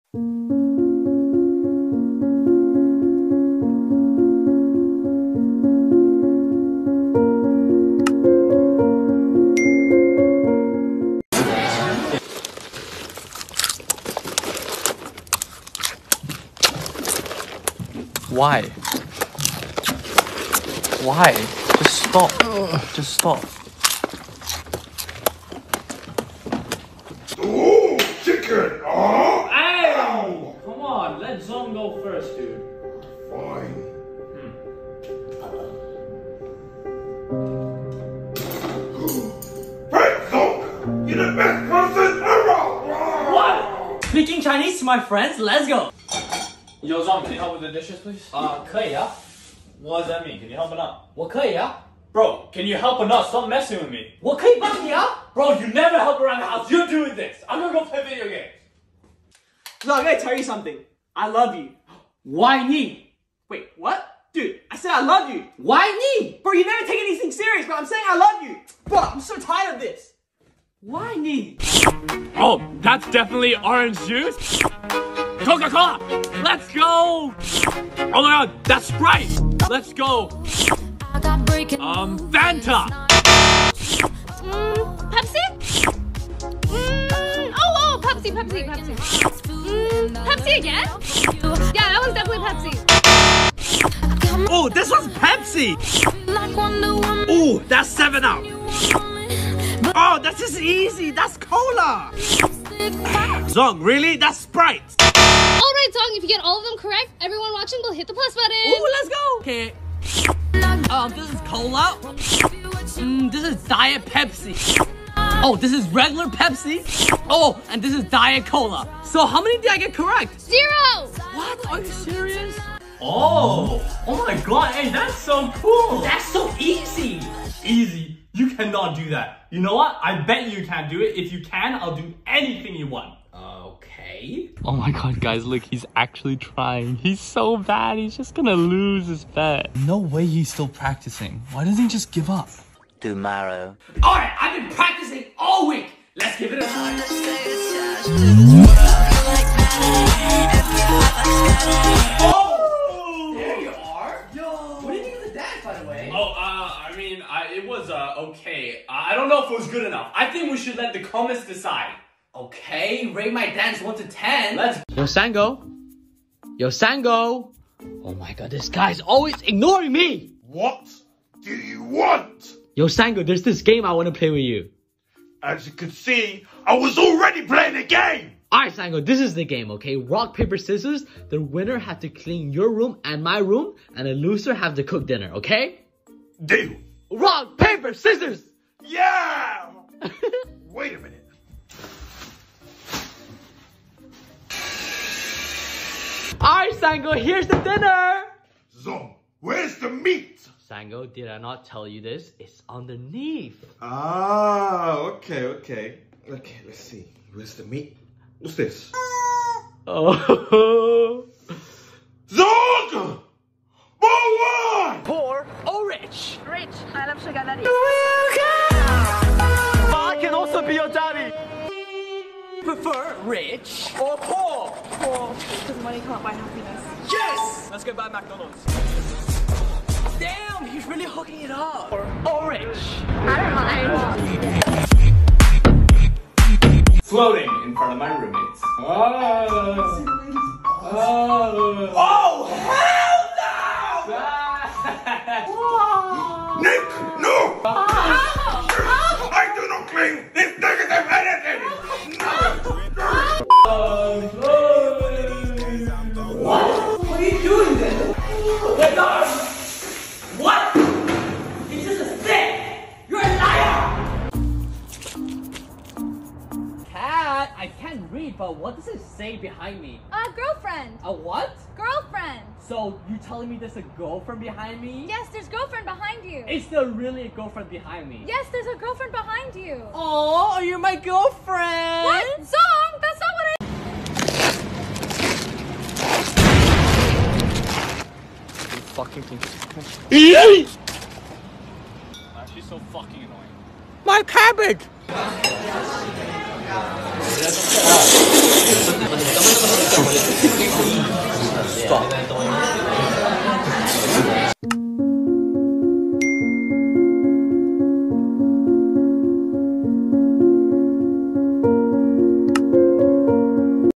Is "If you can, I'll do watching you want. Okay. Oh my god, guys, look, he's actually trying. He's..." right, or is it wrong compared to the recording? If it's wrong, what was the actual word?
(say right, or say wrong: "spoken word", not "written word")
wrong: "anything", not "watching".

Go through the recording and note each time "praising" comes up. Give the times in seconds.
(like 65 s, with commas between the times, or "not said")
not said.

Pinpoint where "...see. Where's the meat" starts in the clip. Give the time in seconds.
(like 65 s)
206 s.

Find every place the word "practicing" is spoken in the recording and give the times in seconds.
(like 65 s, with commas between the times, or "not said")
140 s, 144 s.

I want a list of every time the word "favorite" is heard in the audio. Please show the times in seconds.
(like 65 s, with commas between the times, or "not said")
not said.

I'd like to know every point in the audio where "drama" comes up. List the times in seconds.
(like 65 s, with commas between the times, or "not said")
not said.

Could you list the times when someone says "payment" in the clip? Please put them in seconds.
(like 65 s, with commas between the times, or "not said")
not said.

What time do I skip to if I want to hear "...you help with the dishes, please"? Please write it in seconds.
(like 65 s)
47 s.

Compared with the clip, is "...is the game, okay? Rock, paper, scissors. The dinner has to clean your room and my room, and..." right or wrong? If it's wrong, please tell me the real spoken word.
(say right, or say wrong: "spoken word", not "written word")
wrong: "winner", not "dinner".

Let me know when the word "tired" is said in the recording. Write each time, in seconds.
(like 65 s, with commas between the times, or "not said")
69 s.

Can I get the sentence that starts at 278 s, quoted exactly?
Yes, there's a girlfriend behind you.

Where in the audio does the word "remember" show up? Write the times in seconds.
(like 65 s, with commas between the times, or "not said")
not said.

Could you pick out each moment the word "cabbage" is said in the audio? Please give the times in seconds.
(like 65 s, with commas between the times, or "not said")
294 s.